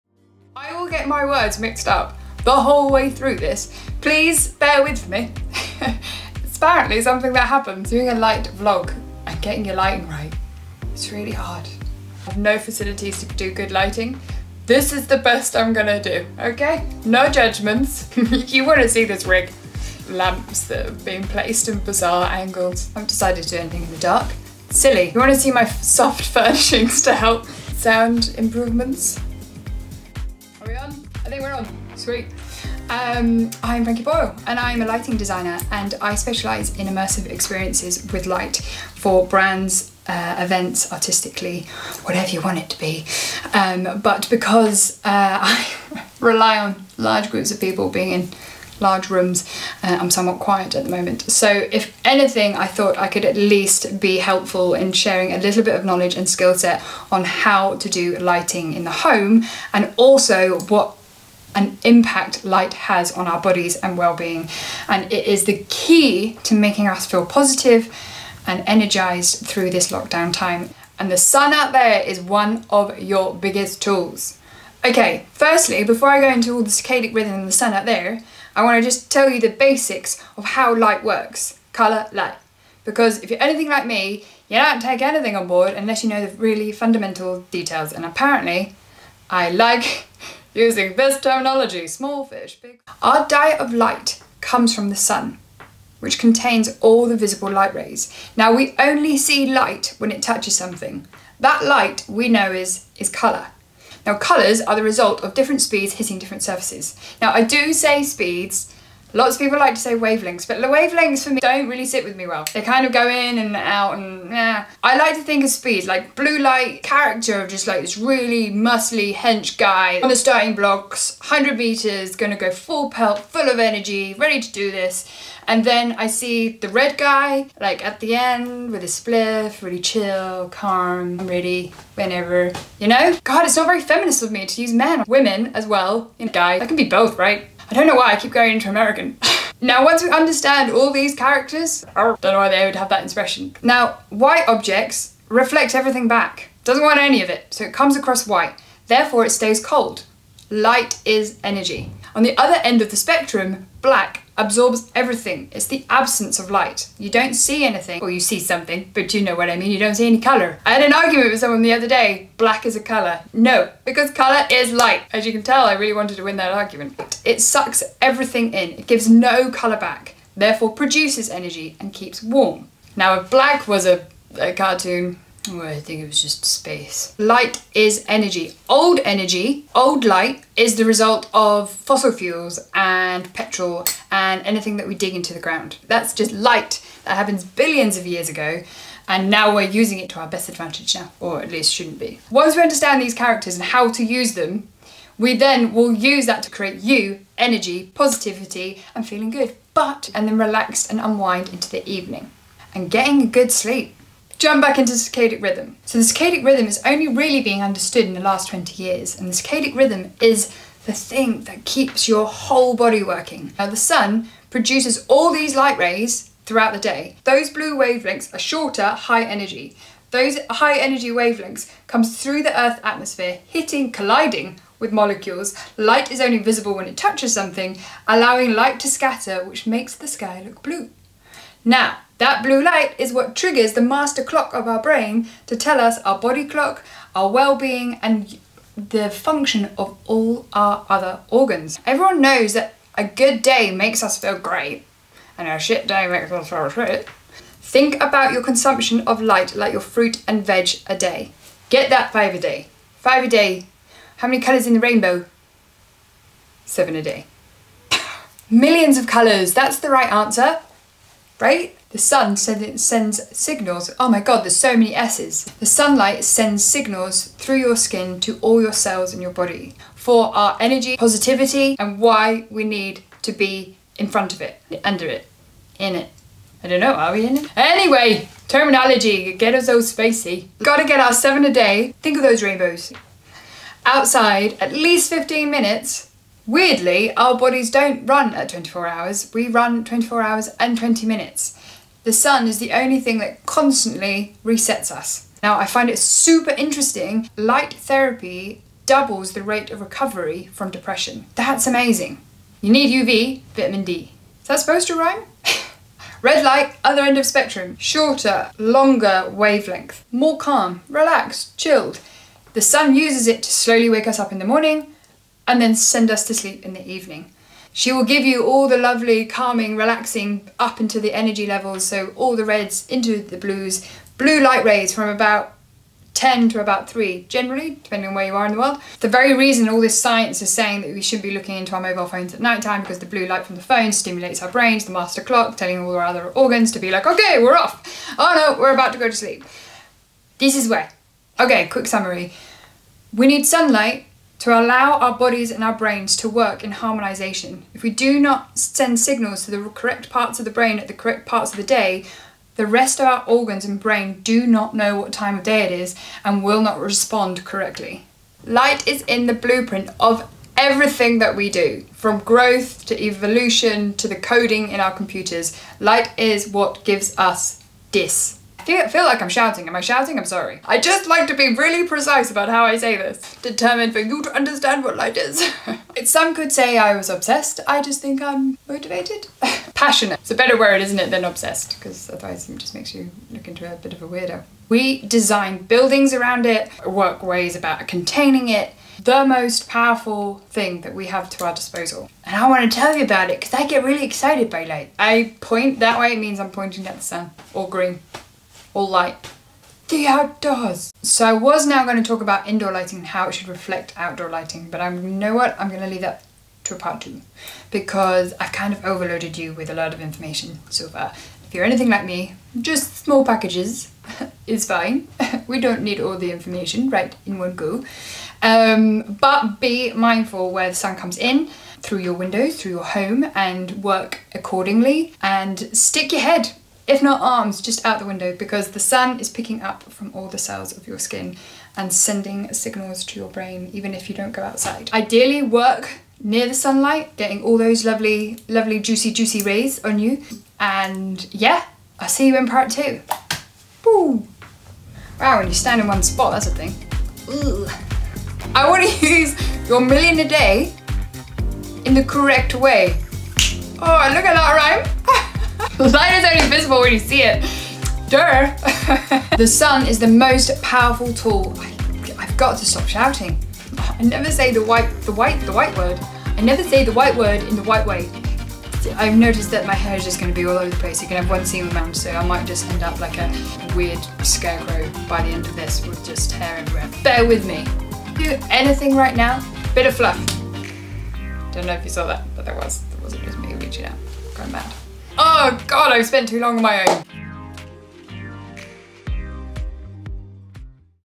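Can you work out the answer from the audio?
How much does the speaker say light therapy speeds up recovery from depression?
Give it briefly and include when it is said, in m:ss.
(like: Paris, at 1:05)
doubles, at 4:58.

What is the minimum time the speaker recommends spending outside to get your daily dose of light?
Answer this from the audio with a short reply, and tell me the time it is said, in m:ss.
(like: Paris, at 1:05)
15 minutes, at 4:44.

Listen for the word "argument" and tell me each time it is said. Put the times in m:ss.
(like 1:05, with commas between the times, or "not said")
2:40, 2:46.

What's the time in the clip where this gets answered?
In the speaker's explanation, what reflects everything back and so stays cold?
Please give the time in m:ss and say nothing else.
2:24.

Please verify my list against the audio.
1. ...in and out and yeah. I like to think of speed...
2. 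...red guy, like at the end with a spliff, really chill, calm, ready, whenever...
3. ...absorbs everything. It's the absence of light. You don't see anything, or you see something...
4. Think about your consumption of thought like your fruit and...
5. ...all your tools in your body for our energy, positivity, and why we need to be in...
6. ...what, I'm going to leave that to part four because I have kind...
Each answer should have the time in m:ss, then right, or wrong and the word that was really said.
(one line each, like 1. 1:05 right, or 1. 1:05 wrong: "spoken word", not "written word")
1. 1:53 right
2. 2:06 right
3. 2:34 right
4. 4:07 wrong: "light", not "thought"
5. 4:28 wrong: "cells", not "tools"
6. 6:45 wrong: "two", not "four".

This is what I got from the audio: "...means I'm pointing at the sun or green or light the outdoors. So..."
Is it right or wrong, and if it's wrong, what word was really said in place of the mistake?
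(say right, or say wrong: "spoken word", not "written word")
right.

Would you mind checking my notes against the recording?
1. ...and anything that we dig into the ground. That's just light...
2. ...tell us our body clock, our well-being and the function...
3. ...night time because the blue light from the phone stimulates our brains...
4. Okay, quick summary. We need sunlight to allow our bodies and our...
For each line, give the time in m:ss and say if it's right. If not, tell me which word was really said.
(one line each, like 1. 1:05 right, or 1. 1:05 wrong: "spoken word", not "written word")
1. 3:04 right
2. 3:55 right
3. 5:32 right
4. 5:41 right.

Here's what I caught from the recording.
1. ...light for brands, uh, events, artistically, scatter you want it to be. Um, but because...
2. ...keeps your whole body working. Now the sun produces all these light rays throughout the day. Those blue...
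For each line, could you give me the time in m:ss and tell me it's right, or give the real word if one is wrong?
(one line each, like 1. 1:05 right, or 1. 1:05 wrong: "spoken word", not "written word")
1. 0:38 wrong: "whatever", not "scatter"
2. 3:31 right.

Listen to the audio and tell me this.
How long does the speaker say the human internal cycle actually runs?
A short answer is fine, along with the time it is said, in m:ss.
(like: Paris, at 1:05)
24 hours 20 minutes, at 4:49.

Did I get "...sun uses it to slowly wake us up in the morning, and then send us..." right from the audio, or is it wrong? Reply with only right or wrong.
right.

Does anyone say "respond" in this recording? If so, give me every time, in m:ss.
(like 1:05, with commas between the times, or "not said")
5:56.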